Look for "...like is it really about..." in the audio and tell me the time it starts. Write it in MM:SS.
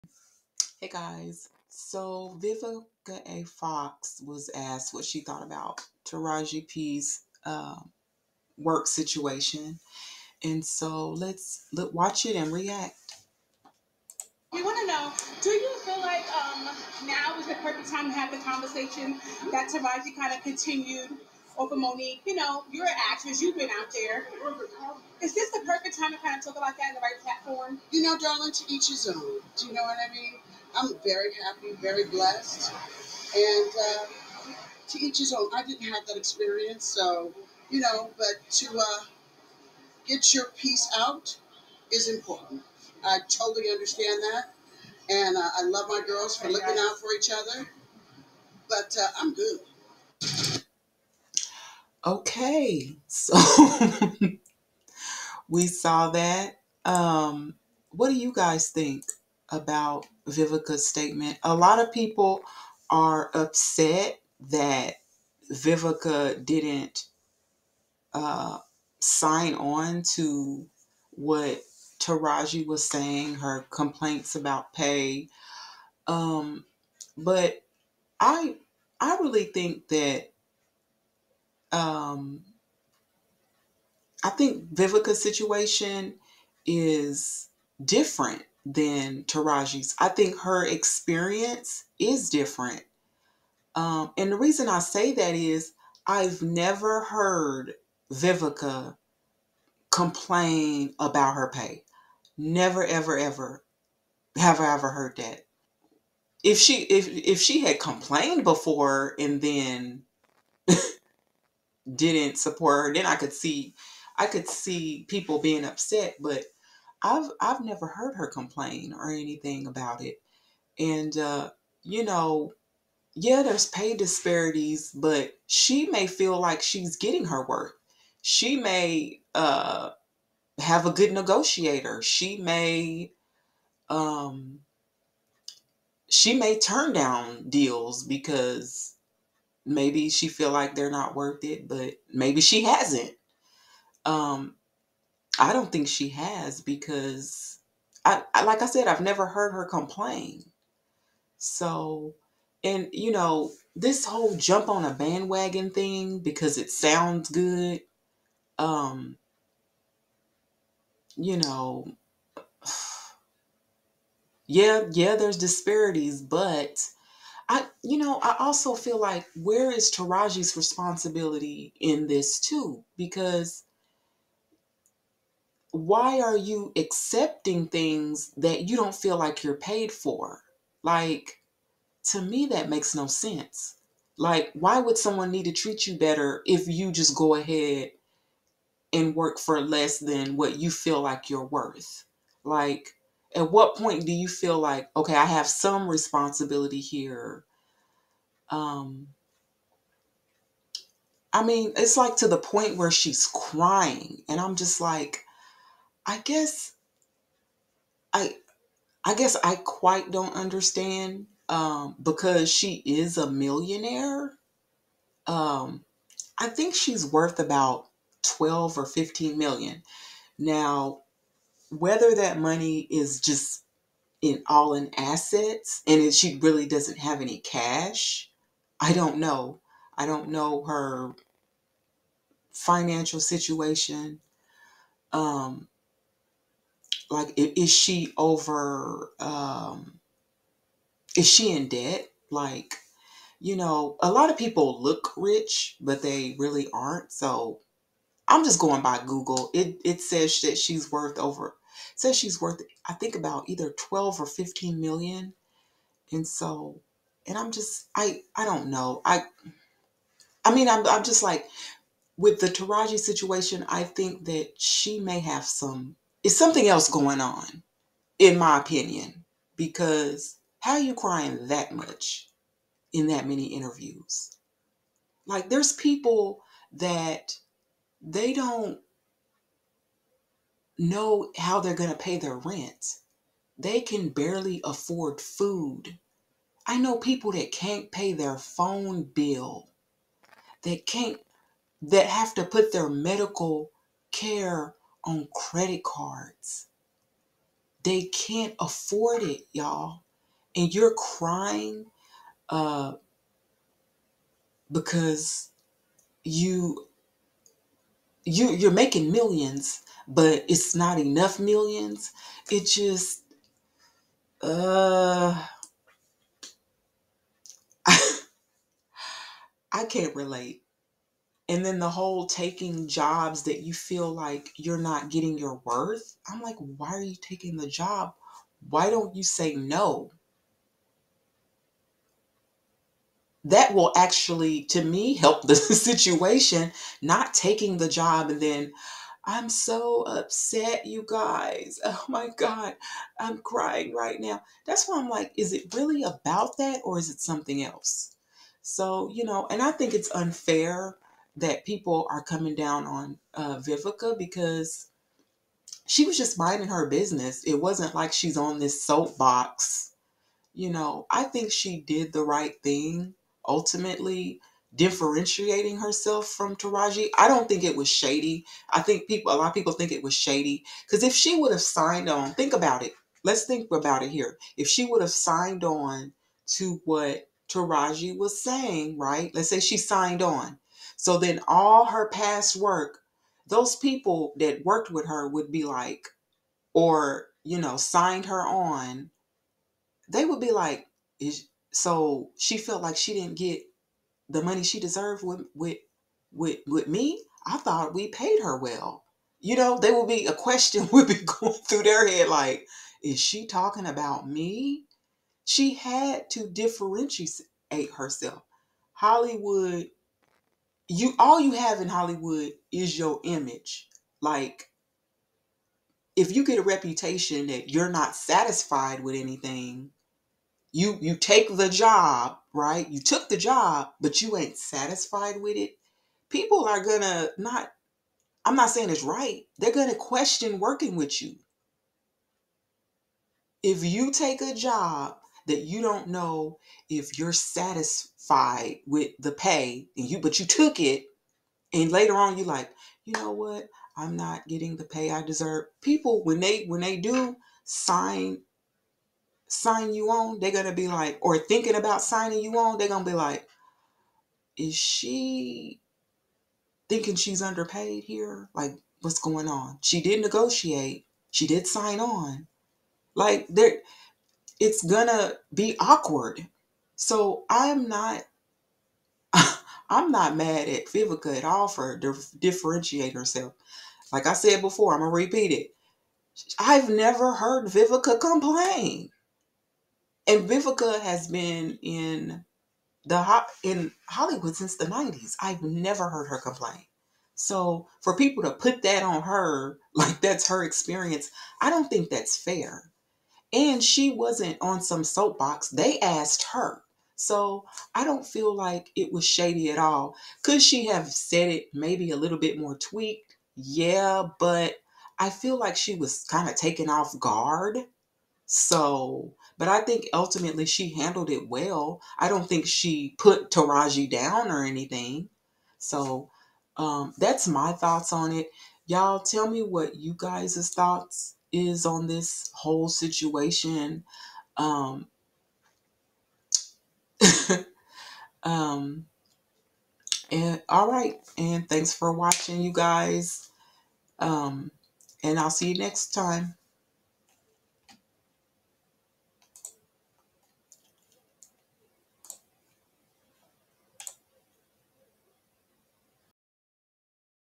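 05:45.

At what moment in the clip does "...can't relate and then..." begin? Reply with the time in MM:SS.
05:19.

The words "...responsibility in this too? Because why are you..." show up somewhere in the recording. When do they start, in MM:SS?
02:50.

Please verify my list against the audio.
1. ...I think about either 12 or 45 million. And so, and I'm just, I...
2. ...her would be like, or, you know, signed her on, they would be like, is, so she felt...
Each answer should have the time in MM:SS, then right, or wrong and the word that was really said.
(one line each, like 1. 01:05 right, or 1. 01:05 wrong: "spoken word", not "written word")
1. 04:12 wrong: "15", not "45"
2. 06:25 right.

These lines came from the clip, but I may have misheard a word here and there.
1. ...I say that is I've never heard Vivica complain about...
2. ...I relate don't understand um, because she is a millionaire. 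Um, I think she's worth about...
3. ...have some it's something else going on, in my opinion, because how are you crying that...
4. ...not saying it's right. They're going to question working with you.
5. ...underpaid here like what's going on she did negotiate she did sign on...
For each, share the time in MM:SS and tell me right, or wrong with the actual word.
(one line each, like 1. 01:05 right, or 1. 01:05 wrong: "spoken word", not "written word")
1. 01:34 right
2. 03:29 wrong: "quite", not "relate"
3. 04:25 right
4. 07:08 right
5. 07:37 right.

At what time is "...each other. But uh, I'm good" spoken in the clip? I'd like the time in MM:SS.
00:47.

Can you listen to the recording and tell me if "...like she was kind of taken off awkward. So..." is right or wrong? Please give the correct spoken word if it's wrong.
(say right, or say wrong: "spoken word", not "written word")
wrong: "guard", not "awkward".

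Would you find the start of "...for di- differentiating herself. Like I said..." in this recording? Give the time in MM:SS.
07:51.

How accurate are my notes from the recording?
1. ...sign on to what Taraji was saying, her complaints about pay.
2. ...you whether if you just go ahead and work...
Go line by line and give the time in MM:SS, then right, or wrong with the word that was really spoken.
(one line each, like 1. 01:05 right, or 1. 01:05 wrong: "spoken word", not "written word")
1. 01:08 right
2. 03:05 wrong: "better", not "whether".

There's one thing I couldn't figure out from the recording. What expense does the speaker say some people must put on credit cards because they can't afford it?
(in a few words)
Medical care.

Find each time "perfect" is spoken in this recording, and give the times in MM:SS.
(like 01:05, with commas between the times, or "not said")
00:17, 00:25.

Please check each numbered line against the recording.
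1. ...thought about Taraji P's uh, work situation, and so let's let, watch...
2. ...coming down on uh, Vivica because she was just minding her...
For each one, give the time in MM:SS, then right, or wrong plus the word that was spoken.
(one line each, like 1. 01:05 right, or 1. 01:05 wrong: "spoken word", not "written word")
1. 00:05 right
2. 05:52 right.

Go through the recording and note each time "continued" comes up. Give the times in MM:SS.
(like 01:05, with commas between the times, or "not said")
00:20.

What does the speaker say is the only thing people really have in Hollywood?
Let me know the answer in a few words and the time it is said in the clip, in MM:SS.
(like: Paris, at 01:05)
Image, at 06:53.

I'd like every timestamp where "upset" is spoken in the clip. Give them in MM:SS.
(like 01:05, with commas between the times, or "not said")
01:03, 01:55, 05:40.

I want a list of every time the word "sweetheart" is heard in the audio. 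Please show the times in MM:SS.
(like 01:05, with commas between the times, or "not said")
not said.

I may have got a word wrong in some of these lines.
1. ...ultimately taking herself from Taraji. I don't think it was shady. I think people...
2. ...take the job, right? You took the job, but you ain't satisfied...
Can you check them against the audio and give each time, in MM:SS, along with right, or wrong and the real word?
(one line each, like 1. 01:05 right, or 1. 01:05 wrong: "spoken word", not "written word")
1. 06:03 wrong: "differentiating", not "taking"
2. 07:01 right.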